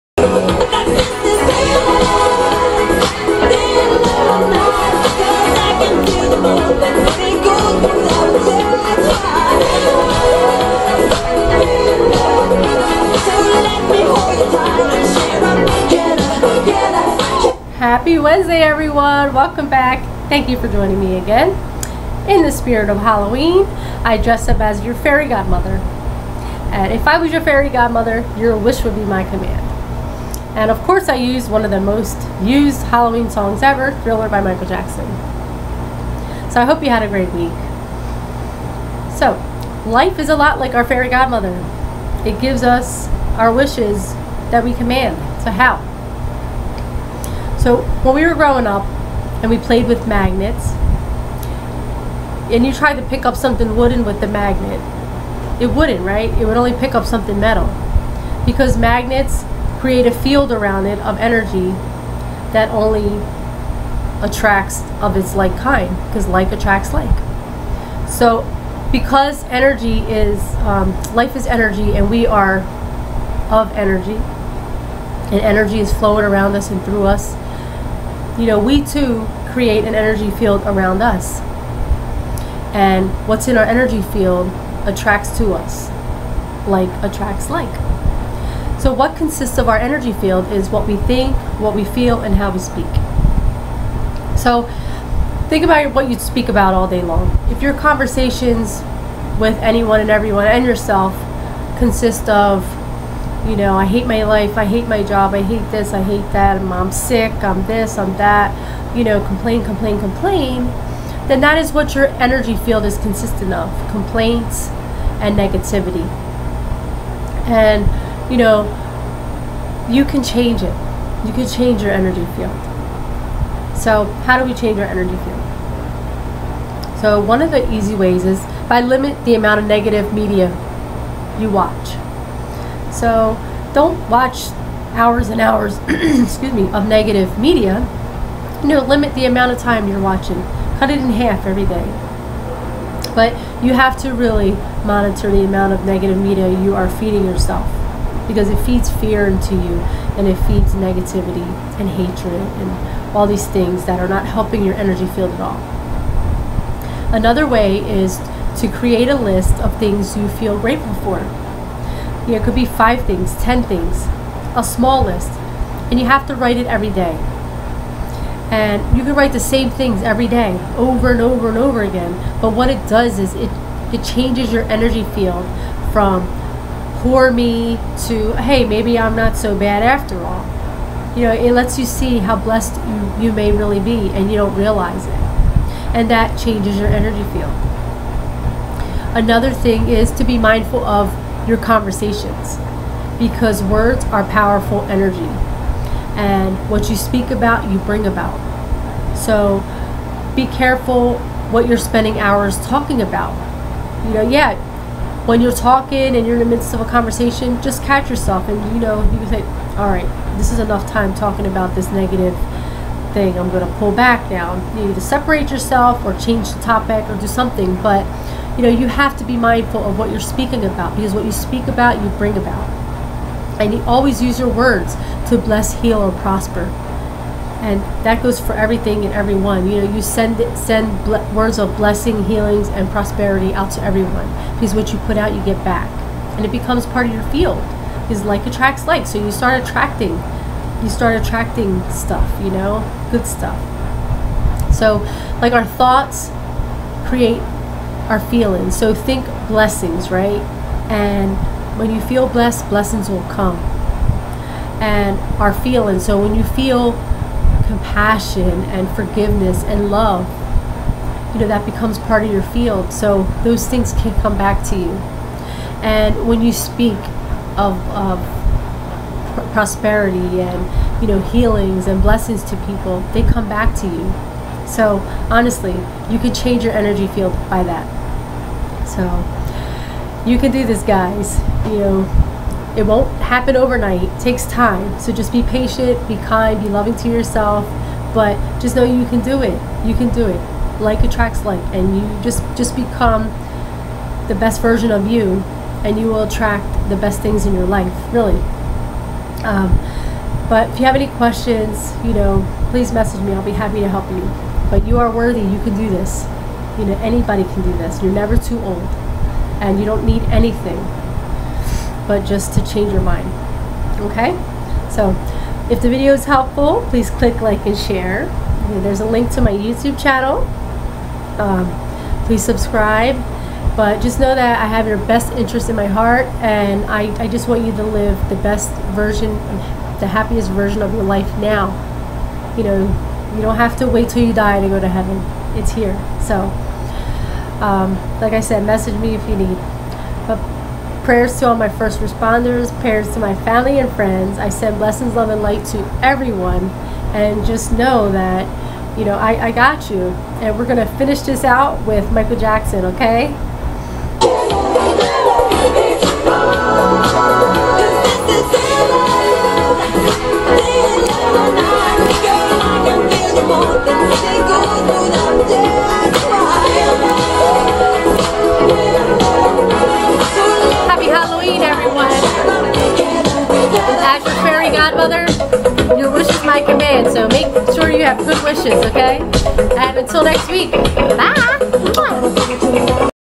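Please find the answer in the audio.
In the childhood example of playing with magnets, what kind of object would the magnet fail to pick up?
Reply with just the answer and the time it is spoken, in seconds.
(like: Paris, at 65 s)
Something wooden, at 53 s.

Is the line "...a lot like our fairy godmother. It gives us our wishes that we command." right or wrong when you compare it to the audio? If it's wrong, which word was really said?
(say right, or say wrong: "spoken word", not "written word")
right.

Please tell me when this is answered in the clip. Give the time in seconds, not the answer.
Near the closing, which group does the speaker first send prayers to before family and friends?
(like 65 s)
341 s.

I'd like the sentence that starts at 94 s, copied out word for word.
So, think about what you speak about all day long.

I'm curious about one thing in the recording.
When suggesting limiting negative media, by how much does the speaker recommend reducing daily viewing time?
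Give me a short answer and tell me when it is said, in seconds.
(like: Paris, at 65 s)
Cut it in half, at 140 s.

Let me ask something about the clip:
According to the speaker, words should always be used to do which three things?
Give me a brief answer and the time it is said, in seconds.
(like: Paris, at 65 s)
Bless, heal, or prosper, at 225 s.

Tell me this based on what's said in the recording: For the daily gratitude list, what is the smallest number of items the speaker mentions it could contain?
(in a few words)
5.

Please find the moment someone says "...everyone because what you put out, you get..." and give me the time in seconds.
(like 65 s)
233 s.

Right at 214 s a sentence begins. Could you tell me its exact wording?
You need to separate yourself or change the topic or do something.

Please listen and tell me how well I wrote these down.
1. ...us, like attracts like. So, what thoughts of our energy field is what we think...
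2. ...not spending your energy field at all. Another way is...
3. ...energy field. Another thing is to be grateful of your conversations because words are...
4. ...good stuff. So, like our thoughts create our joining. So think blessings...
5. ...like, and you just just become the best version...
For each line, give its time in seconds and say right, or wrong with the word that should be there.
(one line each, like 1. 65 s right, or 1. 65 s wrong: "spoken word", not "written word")
1. 85 s wrong: "consists", not "thoughts"
2. 154 s wrong: "helping", not "spending"
3. 186 s wrong: "mindful", not "grateful"
4. 243 s wrong: "feeling", not "joining"
5. 291 s right.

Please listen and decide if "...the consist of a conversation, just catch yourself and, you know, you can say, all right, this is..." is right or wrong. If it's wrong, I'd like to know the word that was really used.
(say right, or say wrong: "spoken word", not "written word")
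wrong: "midst", not "consist".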